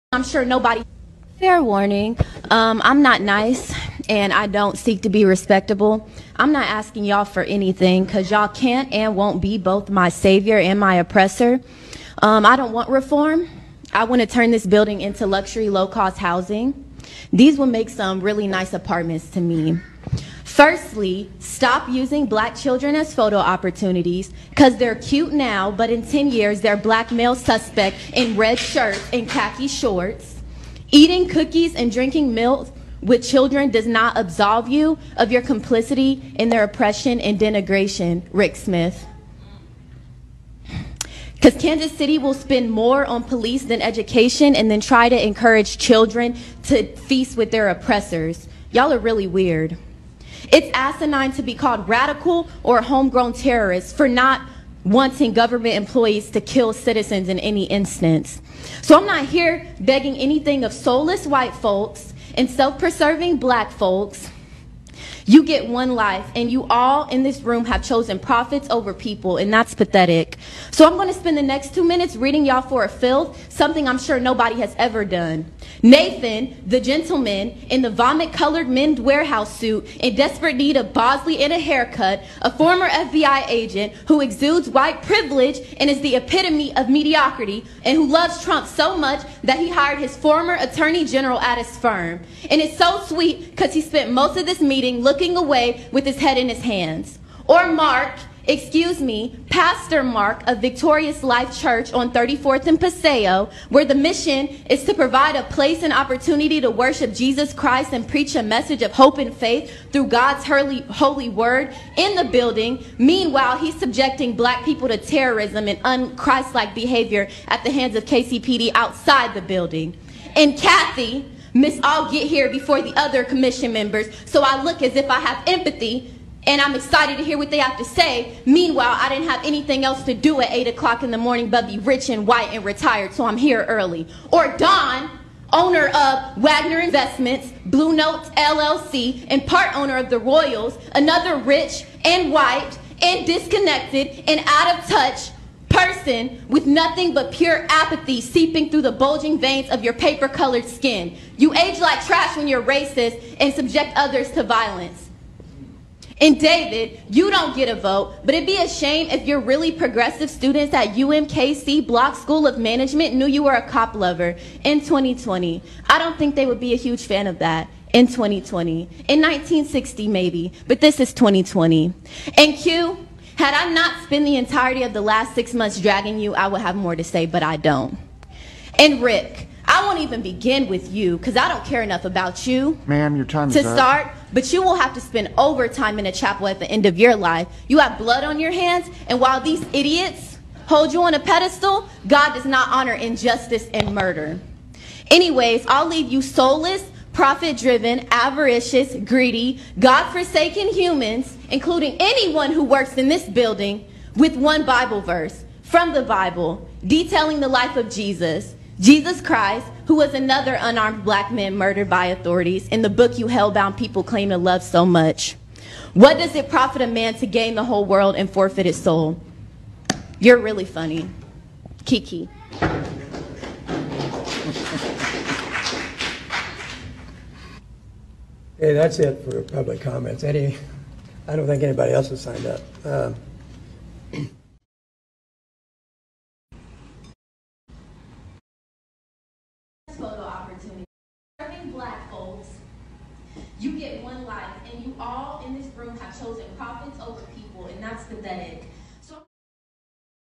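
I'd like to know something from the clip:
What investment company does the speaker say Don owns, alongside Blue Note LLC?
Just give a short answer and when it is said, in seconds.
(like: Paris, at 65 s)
Wagner Investments, at 136 s.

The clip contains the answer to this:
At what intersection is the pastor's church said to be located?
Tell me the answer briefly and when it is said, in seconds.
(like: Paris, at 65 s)
34th and Paseo, at 102 s.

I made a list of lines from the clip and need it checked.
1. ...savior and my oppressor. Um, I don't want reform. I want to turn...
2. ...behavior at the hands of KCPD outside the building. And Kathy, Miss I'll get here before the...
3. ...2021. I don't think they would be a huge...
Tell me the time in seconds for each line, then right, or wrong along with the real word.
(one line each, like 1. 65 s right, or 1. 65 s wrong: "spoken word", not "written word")
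1. 10 s right
2. 116 s right
3. 164 s wrong: "2020", not "2021".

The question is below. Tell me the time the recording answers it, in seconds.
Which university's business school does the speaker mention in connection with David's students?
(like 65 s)
160 s.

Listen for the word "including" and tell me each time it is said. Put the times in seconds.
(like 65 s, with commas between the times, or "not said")
201 s.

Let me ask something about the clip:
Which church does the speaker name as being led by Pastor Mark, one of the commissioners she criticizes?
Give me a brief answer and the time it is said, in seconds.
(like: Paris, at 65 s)
Victorious Life Church, at 100 s.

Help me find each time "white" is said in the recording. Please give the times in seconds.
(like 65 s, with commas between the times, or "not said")
61 s, 84 s, 132 s, 142 s.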